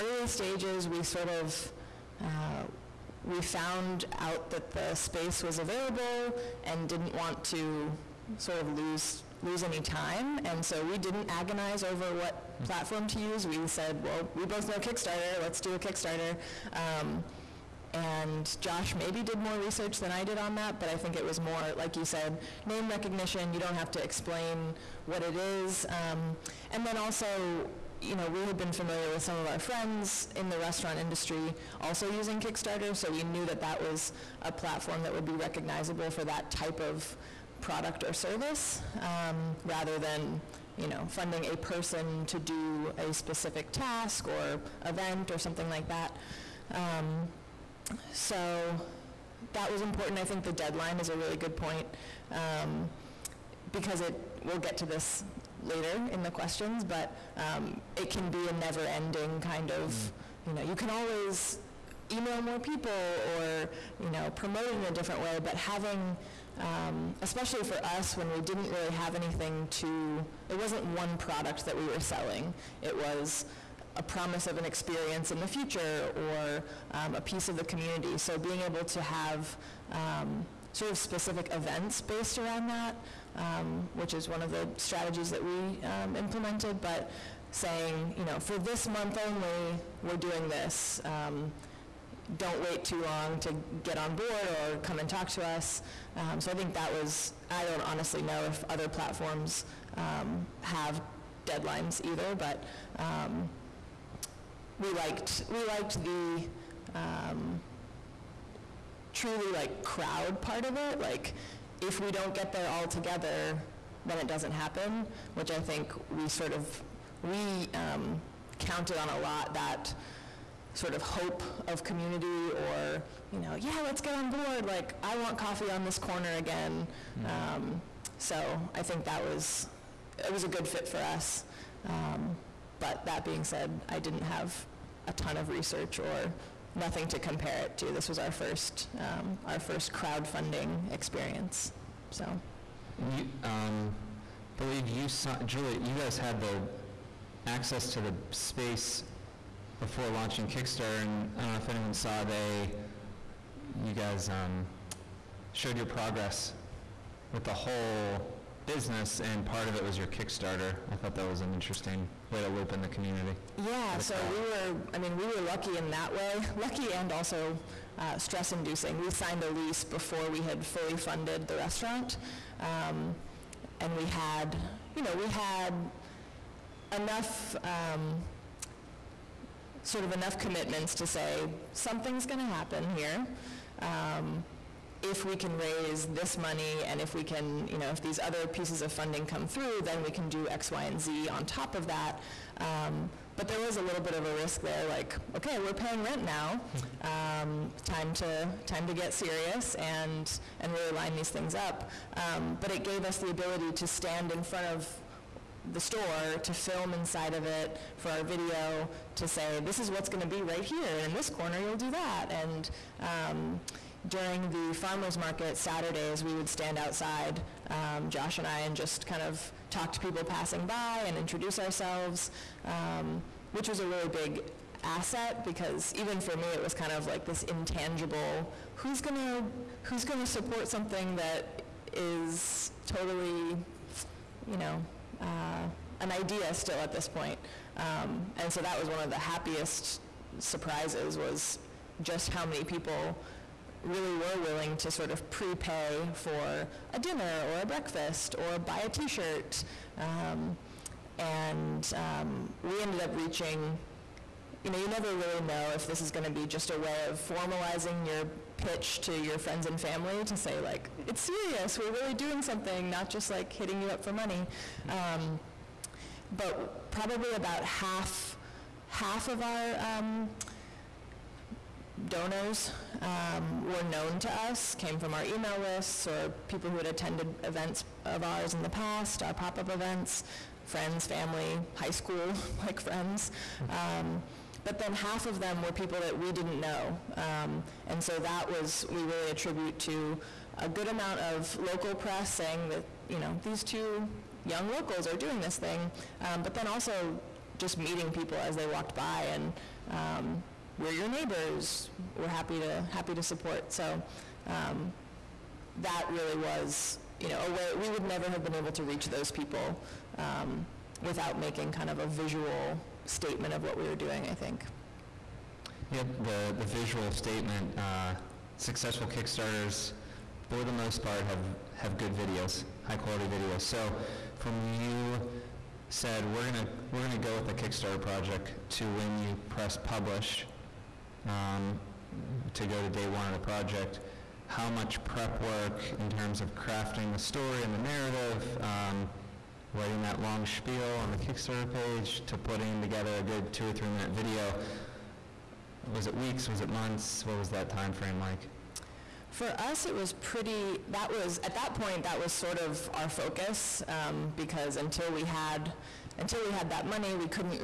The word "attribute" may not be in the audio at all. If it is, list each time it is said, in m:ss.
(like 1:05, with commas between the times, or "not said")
4:49.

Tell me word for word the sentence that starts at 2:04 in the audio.
Like, I want coffee on this corner again.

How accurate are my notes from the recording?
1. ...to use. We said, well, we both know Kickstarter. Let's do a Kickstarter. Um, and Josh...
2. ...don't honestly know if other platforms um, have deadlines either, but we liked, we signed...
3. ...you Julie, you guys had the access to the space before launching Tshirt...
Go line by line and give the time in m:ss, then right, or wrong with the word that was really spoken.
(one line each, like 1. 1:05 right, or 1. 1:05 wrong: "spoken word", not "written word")
1. 0:13 right
2. 1:37 wrong: "liked", not "signed"
3. 2:24 wrong: "Kickstarter", not "Tshirt".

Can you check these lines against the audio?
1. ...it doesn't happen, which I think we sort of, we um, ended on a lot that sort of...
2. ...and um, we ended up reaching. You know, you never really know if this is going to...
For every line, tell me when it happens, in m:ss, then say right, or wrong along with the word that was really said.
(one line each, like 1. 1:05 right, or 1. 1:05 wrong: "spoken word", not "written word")
1. 1:54 wrong: "counted", not "ended"
2. 4:11 right.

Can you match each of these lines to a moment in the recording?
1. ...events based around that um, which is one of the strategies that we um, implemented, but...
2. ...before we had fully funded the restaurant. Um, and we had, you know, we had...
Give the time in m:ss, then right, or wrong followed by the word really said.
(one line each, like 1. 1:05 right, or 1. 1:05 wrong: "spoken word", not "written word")
1. 1:21 right
2. 2:49 right.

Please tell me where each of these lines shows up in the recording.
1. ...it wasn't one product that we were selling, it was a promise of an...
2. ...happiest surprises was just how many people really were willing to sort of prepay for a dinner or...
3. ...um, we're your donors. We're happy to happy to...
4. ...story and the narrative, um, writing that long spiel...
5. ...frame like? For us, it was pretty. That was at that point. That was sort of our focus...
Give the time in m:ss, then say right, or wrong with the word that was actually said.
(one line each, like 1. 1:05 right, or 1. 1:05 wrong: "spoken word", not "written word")
1. 1:10 right
2. 3:59 right
3. 4:59 wrong: "neighbors", not "donors"
4. 5:37 right
5. 5:47 right.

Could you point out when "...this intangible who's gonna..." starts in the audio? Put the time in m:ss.
3:47.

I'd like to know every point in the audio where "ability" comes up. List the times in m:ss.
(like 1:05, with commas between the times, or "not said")
3:23.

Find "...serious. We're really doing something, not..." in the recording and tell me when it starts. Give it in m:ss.
4:21.